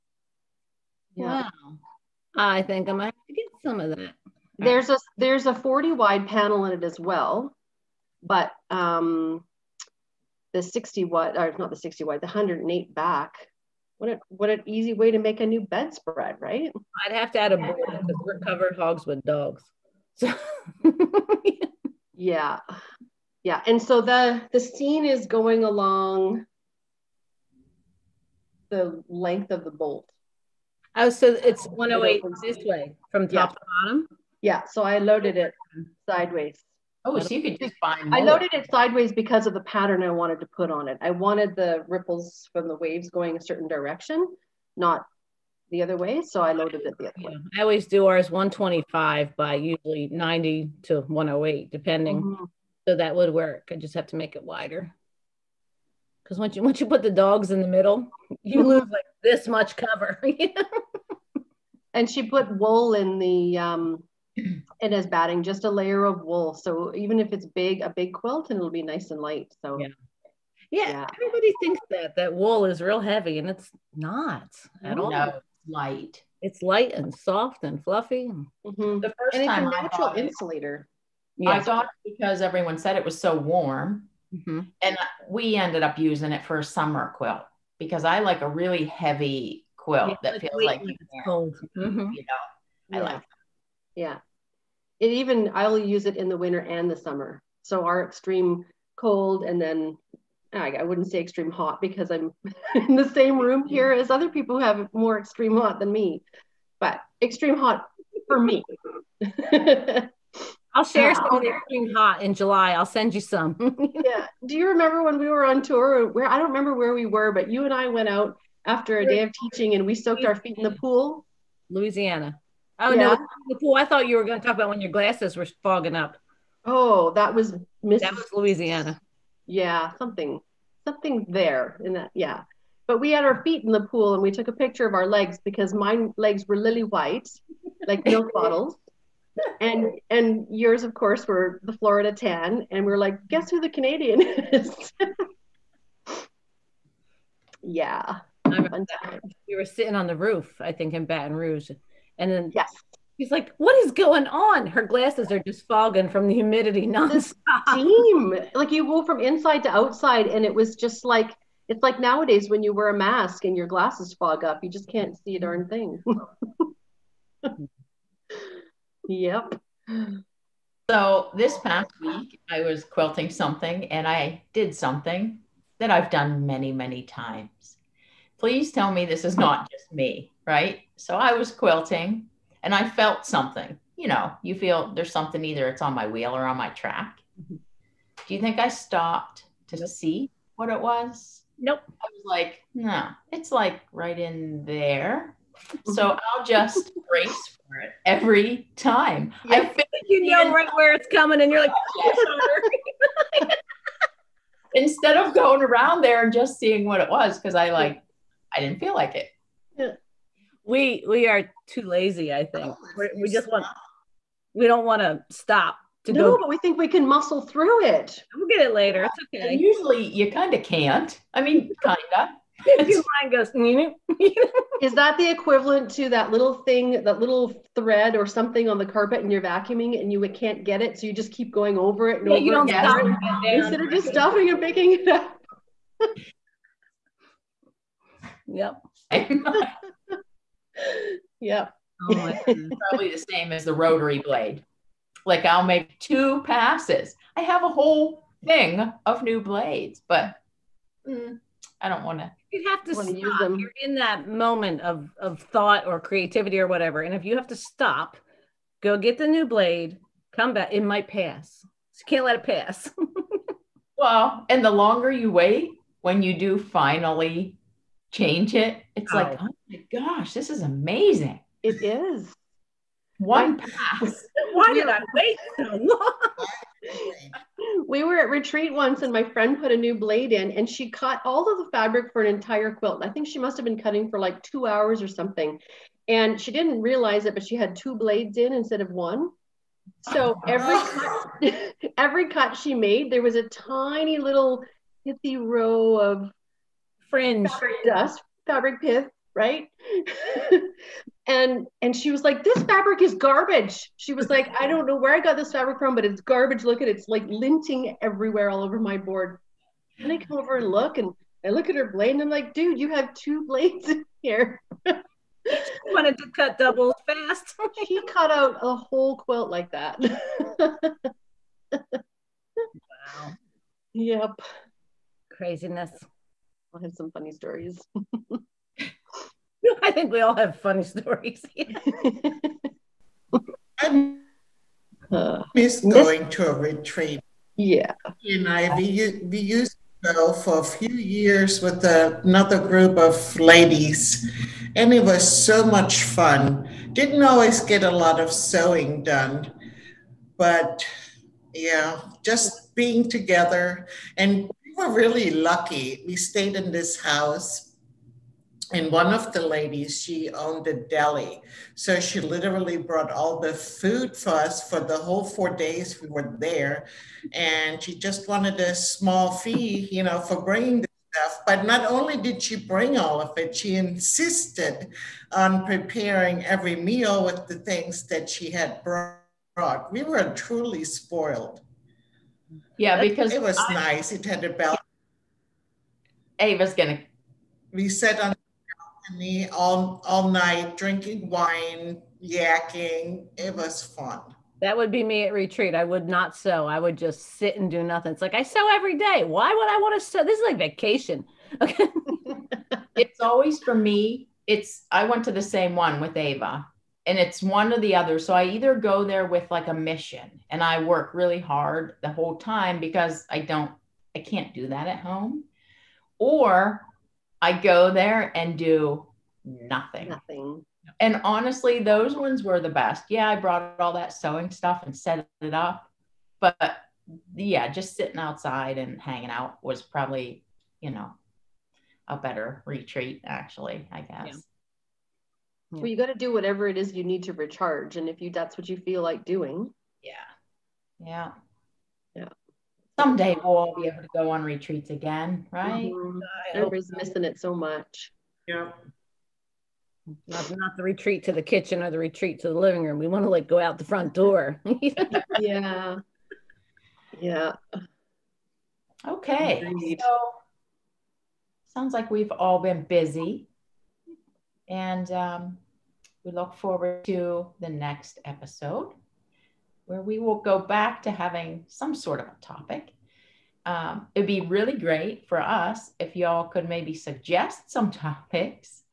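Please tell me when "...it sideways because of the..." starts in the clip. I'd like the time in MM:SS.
00:38.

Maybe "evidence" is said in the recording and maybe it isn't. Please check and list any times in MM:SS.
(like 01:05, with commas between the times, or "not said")
not said.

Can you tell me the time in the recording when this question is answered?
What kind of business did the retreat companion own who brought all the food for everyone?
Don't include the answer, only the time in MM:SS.
06:00.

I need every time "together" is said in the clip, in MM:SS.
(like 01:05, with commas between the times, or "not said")
05:53.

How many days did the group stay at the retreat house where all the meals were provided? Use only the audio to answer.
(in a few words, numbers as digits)
4.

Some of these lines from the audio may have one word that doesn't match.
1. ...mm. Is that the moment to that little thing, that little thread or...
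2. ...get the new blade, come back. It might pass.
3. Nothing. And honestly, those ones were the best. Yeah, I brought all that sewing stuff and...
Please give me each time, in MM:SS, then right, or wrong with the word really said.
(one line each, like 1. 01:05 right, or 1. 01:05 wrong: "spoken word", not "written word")
1. 03:44 wrong: "equivalent", not "moment"
2. 04:18 right
3. 07:00 right.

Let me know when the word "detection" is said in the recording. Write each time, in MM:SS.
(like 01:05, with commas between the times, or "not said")
not said.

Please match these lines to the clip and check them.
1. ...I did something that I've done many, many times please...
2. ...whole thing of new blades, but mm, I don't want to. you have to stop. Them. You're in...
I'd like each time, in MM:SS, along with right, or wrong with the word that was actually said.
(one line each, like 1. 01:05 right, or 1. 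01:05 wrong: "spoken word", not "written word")
1. 02:54 right
2. 04:07 right.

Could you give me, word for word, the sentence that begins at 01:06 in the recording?
So even if it's big, a big quilt, and it'll be nice and light.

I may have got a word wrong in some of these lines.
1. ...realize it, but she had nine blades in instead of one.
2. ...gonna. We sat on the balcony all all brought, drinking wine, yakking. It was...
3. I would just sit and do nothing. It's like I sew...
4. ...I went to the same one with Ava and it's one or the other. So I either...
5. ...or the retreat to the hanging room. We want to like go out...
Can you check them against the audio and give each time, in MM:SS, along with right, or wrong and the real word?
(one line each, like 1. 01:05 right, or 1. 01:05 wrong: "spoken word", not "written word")
1. 04:46 wrong: "two", not "nine"
2. 06:26 wrong: "night", not "brought"
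3. 06:36 right
4. 06:44 right
5. 07:31 wrong: "living", not "hanging".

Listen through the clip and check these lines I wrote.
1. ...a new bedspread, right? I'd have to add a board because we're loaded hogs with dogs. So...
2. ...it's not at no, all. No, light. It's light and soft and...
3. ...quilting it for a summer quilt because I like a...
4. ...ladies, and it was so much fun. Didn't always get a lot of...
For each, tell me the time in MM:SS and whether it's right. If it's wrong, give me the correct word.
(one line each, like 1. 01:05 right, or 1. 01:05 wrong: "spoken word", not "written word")
1. 00:15 wrong: "covered", not "loaded"
2. 01:13 right
3. 01:25 wrong: "using", not "quilting"
4. 05:43 right.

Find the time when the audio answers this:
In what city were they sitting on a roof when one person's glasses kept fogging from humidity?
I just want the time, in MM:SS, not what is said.
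02:31.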